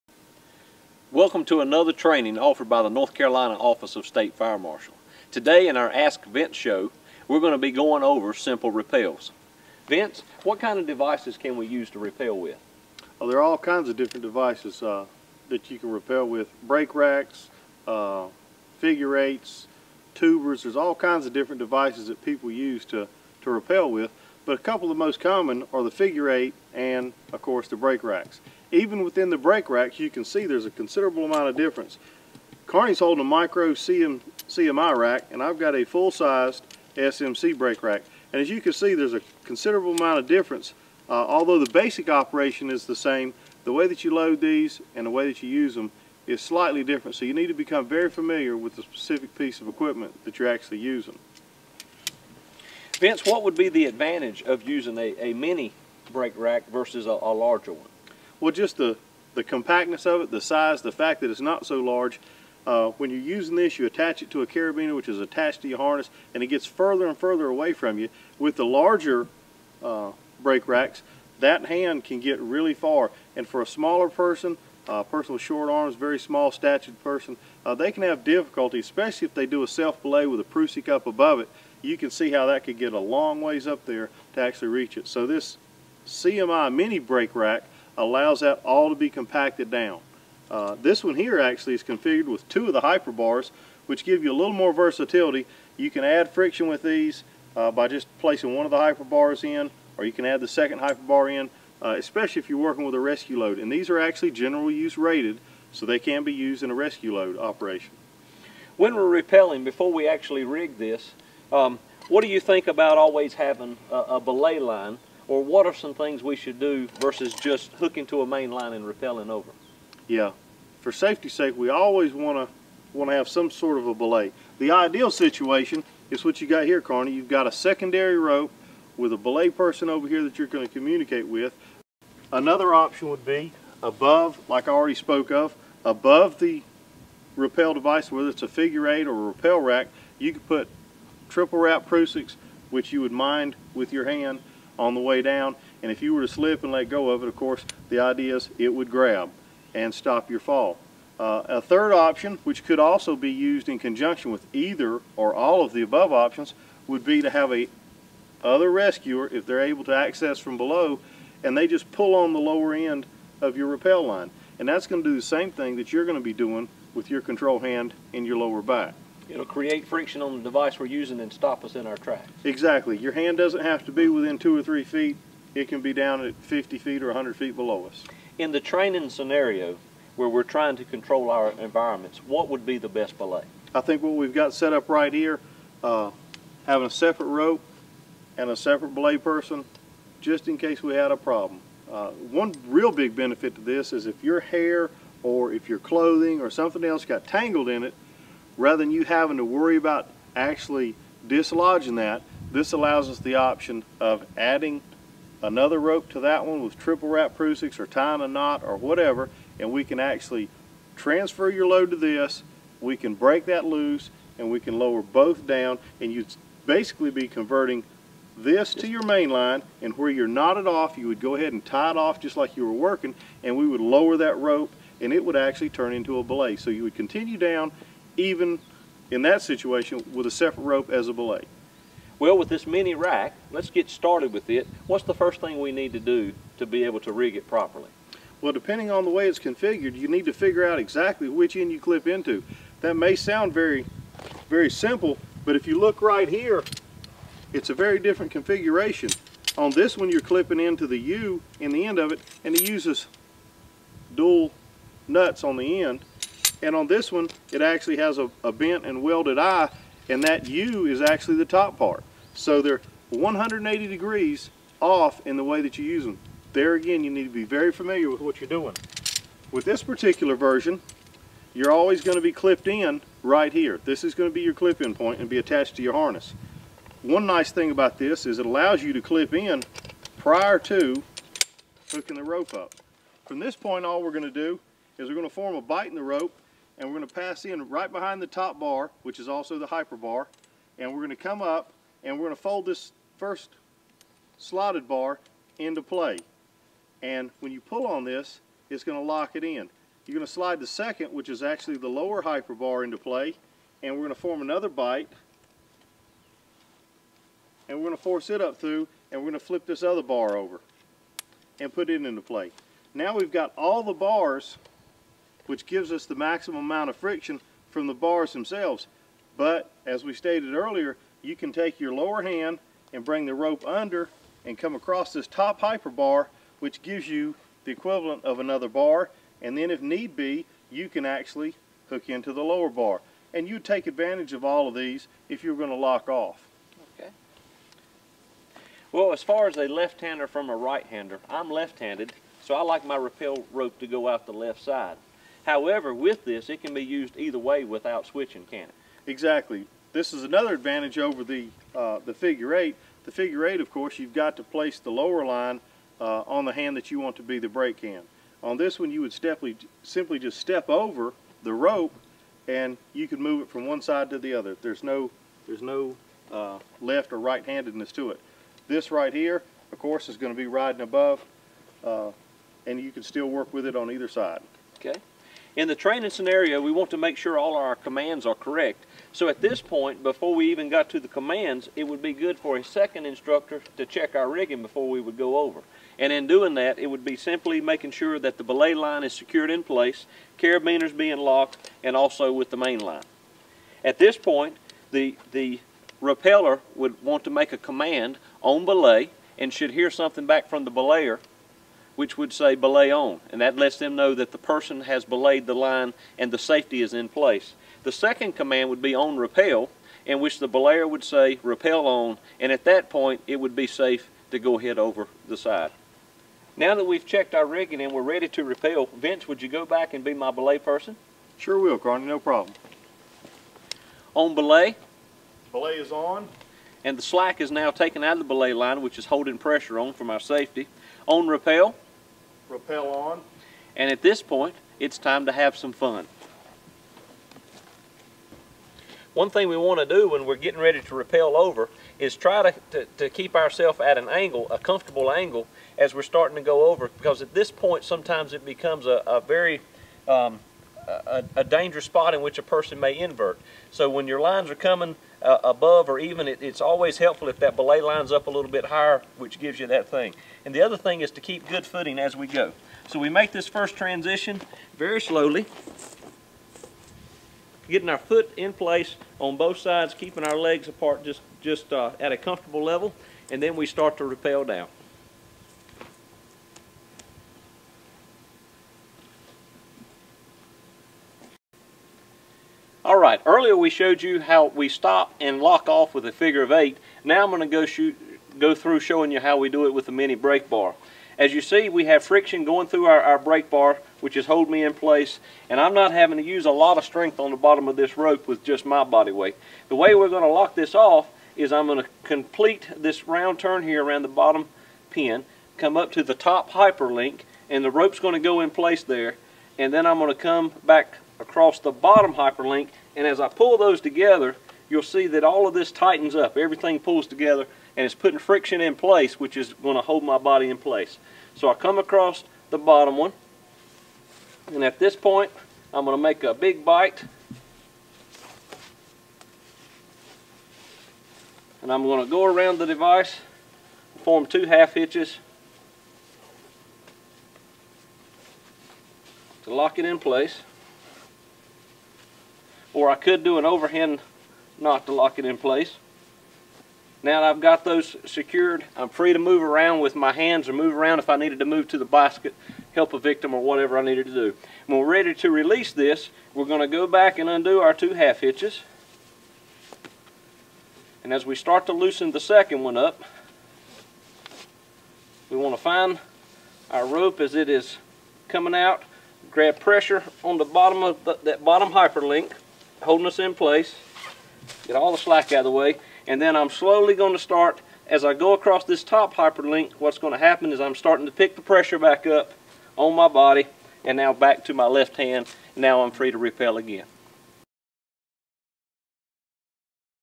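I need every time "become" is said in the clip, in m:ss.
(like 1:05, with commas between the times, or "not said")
0:47, 7:28.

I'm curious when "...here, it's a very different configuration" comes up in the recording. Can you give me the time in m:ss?
4:06.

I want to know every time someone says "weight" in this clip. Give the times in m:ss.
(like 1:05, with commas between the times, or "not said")
8:19.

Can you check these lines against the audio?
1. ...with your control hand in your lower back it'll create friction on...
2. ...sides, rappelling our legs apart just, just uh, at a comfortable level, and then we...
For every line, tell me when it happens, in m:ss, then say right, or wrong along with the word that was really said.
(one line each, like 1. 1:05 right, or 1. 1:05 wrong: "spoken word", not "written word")
1. 2:46 right
2. 7:49 wrong: "keeping", not "rappelling".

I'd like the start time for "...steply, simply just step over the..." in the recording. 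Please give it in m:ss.
5:59.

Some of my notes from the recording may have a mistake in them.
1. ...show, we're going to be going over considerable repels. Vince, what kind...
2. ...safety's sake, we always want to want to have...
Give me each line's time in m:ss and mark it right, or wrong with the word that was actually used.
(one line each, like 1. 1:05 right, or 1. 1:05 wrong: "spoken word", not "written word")
1. 0:06 wrong: "simple", not "considerable"
2. 2:00 right.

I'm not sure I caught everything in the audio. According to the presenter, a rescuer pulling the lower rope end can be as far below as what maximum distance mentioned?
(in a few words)
100 feet.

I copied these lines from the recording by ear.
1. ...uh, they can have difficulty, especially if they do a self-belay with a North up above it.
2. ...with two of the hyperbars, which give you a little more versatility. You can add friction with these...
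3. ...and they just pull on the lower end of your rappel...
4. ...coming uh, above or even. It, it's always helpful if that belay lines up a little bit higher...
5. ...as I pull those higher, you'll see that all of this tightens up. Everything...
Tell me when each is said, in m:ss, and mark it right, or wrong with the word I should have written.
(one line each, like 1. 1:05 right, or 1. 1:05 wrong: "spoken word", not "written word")
1. 1:17 wrong: "Prusik", not "North"
2. 1:32 right
3. 2:41 right
4. 7:34 right
5. 8:33 wrong: "together", not "higher".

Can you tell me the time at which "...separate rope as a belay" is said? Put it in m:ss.
3:50.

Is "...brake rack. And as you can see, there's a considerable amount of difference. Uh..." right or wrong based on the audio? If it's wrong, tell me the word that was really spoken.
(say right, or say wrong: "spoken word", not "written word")
right.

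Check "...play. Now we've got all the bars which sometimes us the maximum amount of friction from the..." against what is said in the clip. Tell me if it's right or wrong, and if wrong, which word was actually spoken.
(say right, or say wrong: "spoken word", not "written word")
wrong: "gives", not "sometimes".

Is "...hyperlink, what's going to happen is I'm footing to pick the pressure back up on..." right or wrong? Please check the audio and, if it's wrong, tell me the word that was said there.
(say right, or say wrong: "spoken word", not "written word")
wrong: "starting", not "footing".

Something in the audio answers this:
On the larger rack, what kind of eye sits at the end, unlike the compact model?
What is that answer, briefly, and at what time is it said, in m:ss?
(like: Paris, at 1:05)
a bent and welded eye, at 4:18.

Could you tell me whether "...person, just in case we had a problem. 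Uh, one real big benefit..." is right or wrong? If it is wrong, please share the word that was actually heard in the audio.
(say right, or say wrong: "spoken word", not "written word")
right.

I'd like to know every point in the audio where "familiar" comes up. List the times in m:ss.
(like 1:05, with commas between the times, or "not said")
0:48, 4:27.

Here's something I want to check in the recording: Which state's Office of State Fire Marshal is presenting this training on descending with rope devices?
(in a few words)
North Carolina.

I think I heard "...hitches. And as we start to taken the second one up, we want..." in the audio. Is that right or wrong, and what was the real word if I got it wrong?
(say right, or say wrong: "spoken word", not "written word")
wrong: "loosen", not "taken".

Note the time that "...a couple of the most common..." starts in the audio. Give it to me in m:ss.
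0:24.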